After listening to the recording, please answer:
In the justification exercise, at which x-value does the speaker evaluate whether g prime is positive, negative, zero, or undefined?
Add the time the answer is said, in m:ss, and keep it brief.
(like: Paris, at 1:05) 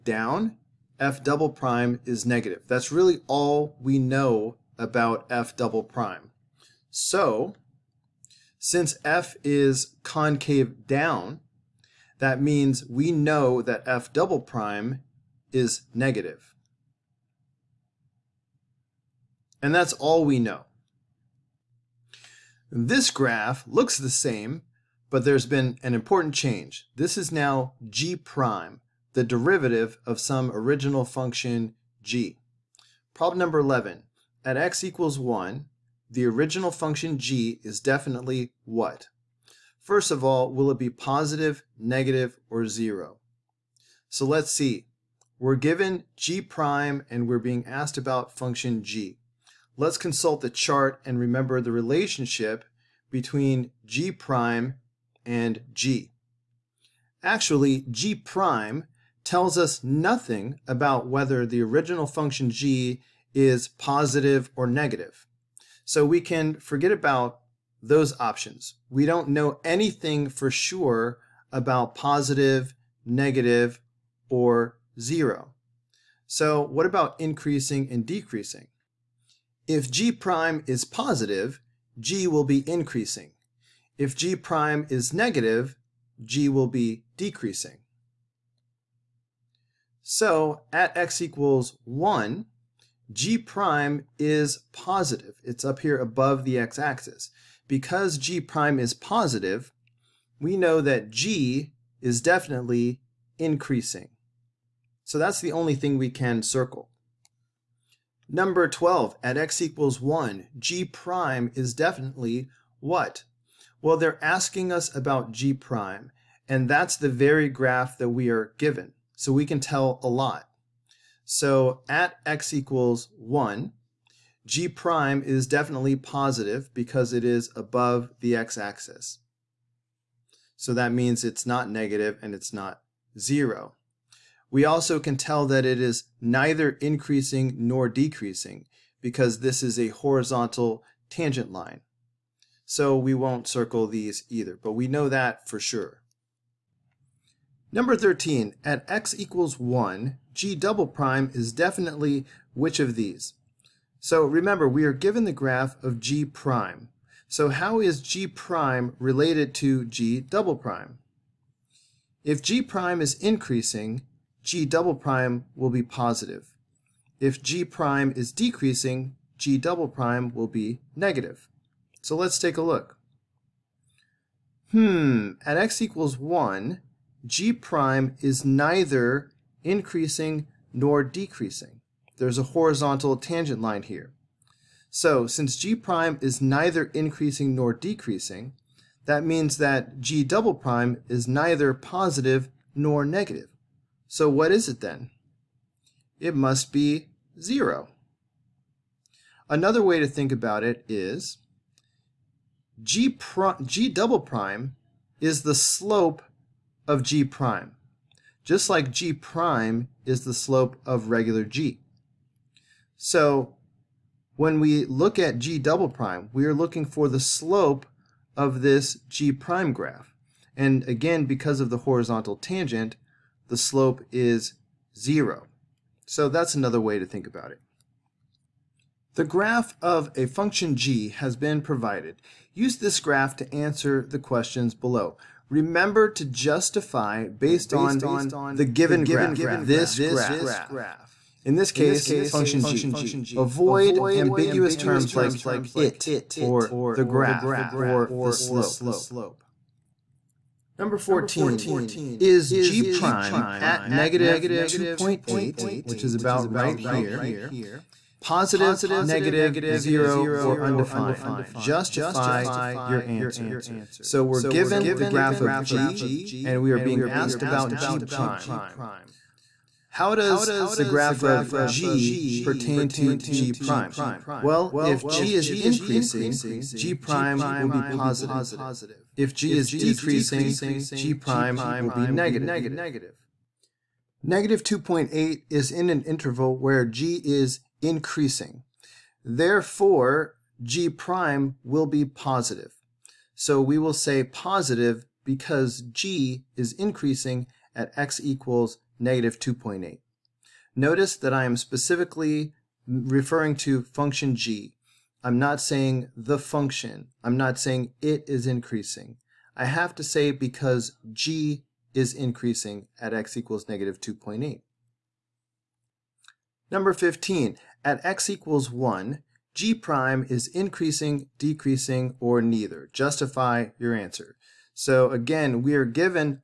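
-2.8, at 4:13.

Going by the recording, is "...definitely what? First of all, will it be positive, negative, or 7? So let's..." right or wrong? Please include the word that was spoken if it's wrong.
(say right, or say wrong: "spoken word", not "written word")
wrong: "0", not "7".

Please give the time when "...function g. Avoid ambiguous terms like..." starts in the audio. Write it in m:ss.
4:02.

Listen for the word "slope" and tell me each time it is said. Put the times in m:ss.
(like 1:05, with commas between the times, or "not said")
3:25, 3:30, 3:37, 3:43, 4:08.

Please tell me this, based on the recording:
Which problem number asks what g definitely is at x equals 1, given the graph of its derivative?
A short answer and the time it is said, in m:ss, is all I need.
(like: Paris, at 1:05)
11, at 0:33.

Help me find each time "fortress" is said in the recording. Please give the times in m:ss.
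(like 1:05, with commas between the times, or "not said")
not said.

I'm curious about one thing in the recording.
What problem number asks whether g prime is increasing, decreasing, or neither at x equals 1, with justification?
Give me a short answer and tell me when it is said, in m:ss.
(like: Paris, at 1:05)
15, at 5:16.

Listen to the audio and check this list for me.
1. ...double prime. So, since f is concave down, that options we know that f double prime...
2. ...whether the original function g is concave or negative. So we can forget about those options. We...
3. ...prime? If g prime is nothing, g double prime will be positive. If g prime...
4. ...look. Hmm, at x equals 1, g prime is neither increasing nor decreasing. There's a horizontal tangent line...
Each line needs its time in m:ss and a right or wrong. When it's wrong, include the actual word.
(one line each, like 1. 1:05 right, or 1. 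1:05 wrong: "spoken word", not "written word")
1. 0:05 wrong: "means", not "options"
2. 1:01 wrong: "positive", not "concave"
3. 2:40 wrong: "increasing", not "nothing"
4. 2:52 right.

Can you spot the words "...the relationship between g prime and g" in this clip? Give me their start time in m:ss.
0:51.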